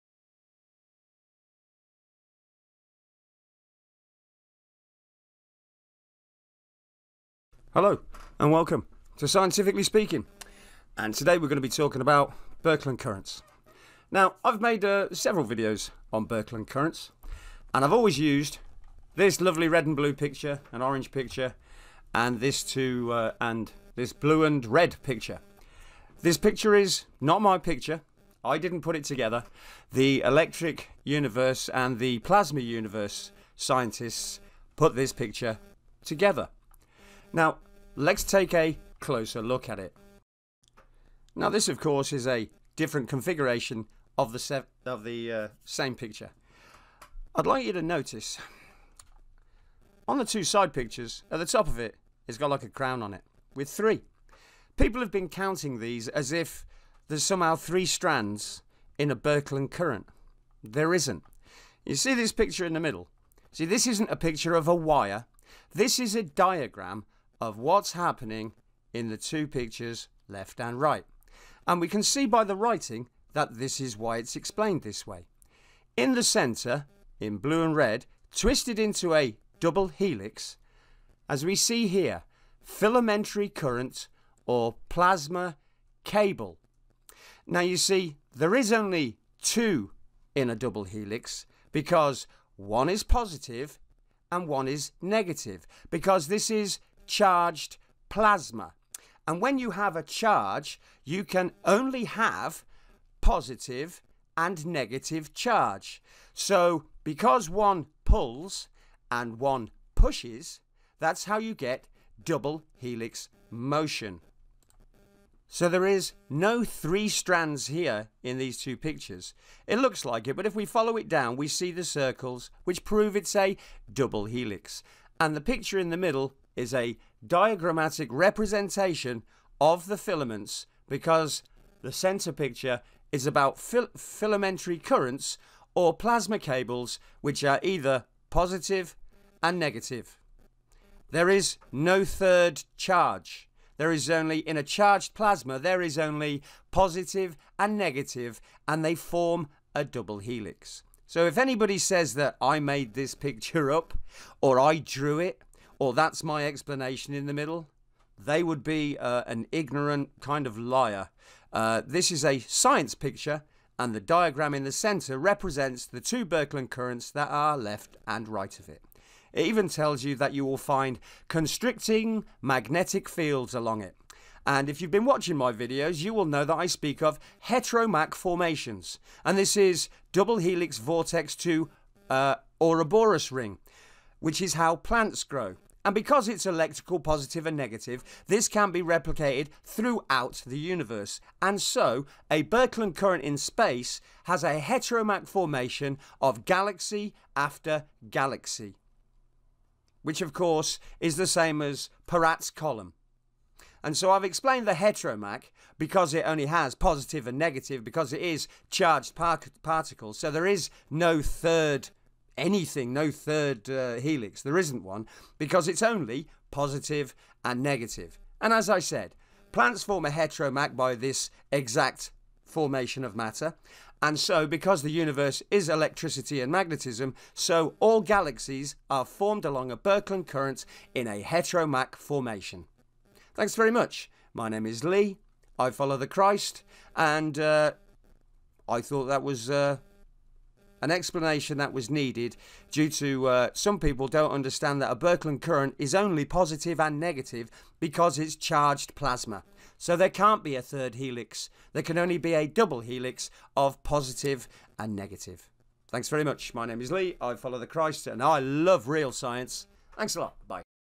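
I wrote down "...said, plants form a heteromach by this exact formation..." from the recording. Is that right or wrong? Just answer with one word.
right.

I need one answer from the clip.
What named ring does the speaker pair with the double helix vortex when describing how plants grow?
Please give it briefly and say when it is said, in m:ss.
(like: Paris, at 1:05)
Ouroboros ring, at 3:02.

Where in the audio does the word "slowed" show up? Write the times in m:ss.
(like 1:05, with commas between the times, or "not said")
not said.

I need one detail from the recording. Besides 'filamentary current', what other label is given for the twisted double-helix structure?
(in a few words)
Plasma cable.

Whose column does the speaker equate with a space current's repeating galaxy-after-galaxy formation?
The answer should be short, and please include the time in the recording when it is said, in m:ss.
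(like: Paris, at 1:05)
Peratt's column, at 3:22.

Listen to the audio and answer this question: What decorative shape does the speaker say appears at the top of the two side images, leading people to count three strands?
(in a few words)
A crown.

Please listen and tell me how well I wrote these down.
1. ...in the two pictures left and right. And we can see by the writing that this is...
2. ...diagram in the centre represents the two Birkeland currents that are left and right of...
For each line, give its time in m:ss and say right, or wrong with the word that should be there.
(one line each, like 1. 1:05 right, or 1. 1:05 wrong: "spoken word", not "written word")
1. 1:08 right
2. 2:43 right.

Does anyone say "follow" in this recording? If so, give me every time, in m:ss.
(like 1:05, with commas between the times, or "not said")
2:00, 3:55, 4:17.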